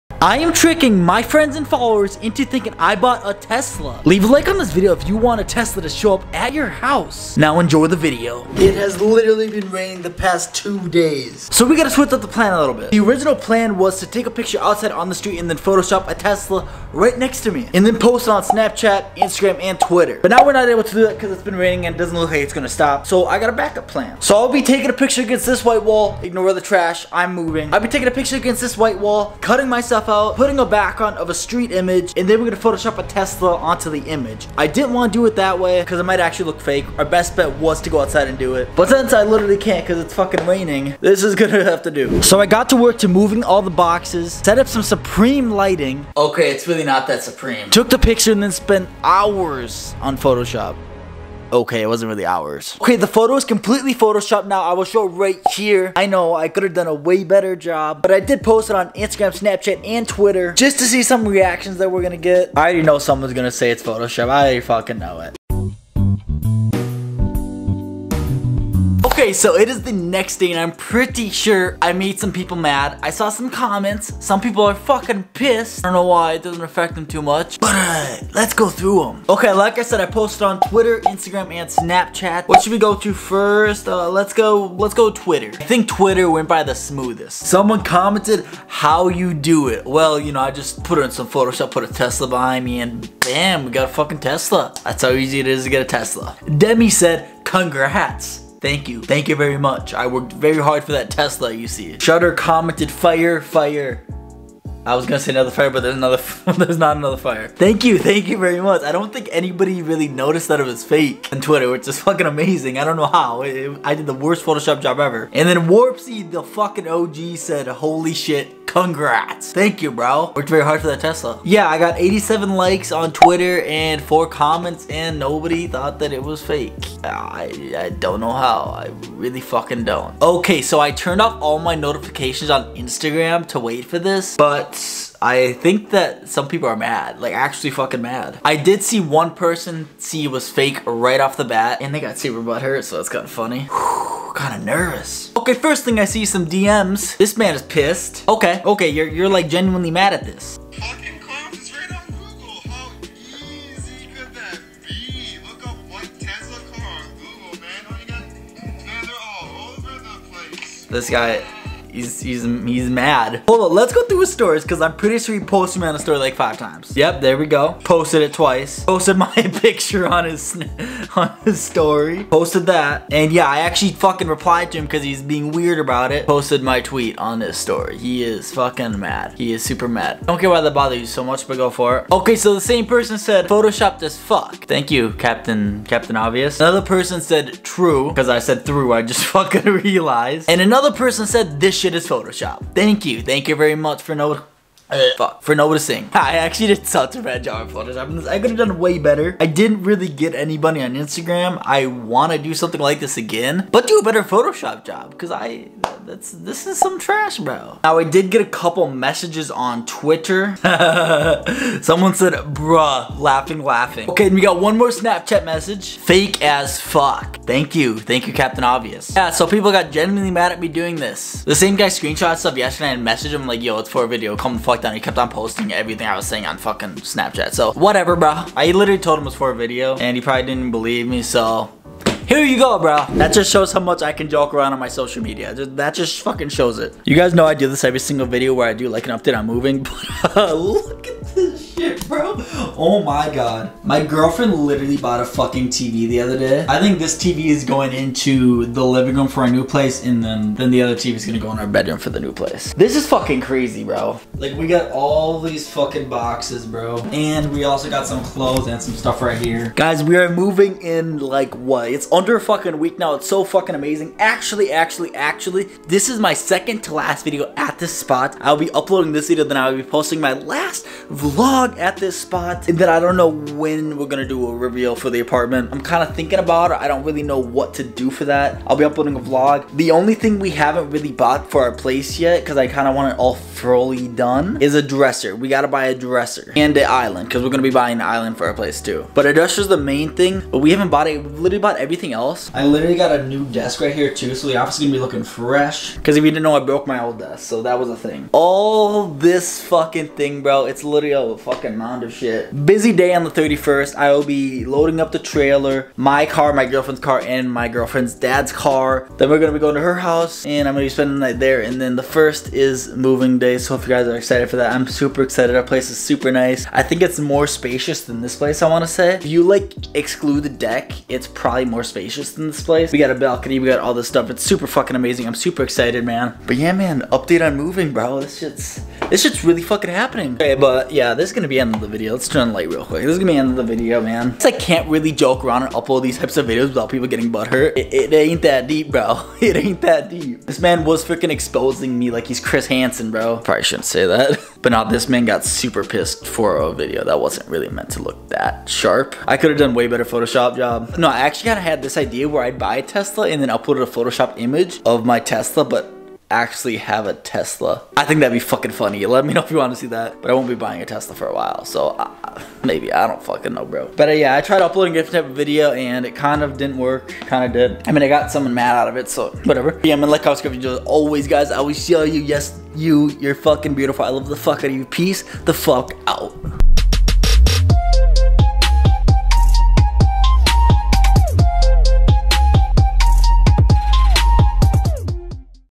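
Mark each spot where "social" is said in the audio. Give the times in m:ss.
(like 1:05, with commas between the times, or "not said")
3:54.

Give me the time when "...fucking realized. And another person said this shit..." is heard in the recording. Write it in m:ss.
3:09.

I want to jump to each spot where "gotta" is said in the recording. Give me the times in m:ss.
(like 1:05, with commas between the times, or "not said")
0:11, 4:45.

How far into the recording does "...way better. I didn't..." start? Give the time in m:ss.
3:18.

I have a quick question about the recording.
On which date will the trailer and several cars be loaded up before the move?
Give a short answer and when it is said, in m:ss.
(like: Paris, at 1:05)
The 31st, at 5:03.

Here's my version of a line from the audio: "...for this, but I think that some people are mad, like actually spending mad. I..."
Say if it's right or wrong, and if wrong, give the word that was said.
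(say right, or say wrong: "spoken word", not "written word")
wrong: "fucking", not "spending".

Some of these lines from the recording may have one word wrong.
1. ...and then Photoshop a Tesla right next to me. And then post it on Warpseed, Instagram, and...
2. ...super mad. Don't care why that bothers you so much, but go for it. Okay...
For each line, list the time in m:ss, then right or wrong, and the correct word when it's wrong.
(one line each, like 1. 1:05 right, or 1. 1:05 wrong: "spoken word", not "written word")
1. 0:15 wrong: "Snapchat", not "Warpseed"
2. 2:59 right.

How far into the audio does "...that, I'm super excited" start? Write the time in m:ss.
5:14.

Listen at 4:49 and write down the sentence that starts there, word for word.
But a dresser is the main thing, but we haven't bought it.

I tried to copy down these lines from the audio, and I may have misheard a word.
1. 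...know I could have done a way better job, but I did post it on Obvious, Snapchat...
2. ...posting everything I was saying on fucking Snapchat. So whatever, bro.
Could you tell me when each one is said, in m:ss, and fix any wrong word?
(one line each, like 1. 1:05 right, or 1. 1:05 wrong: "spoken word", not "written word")
1. 0:56 wrong: "Instagram", not "Obvious"
2. 3:45 right.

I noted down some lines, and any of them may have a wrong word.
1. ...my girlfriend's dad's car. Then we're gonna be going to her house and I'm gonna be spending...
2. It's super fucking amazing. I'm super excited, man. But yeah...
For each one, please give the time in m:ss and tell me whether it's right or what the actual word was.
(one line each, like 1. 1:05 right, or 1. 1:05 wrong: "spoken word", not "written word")
1. 5:07 right
2. 5:24 right.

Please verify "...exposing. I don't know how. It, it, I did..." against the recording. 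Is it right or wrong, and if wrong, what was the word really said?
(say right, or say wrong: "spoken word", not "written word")
wrong: "amazing", not "exposing".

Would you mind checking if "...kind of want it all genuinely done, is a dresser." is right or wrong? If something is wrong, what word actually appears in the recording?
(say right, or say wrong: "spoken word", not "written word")
wrong: "fully", not "genuinely".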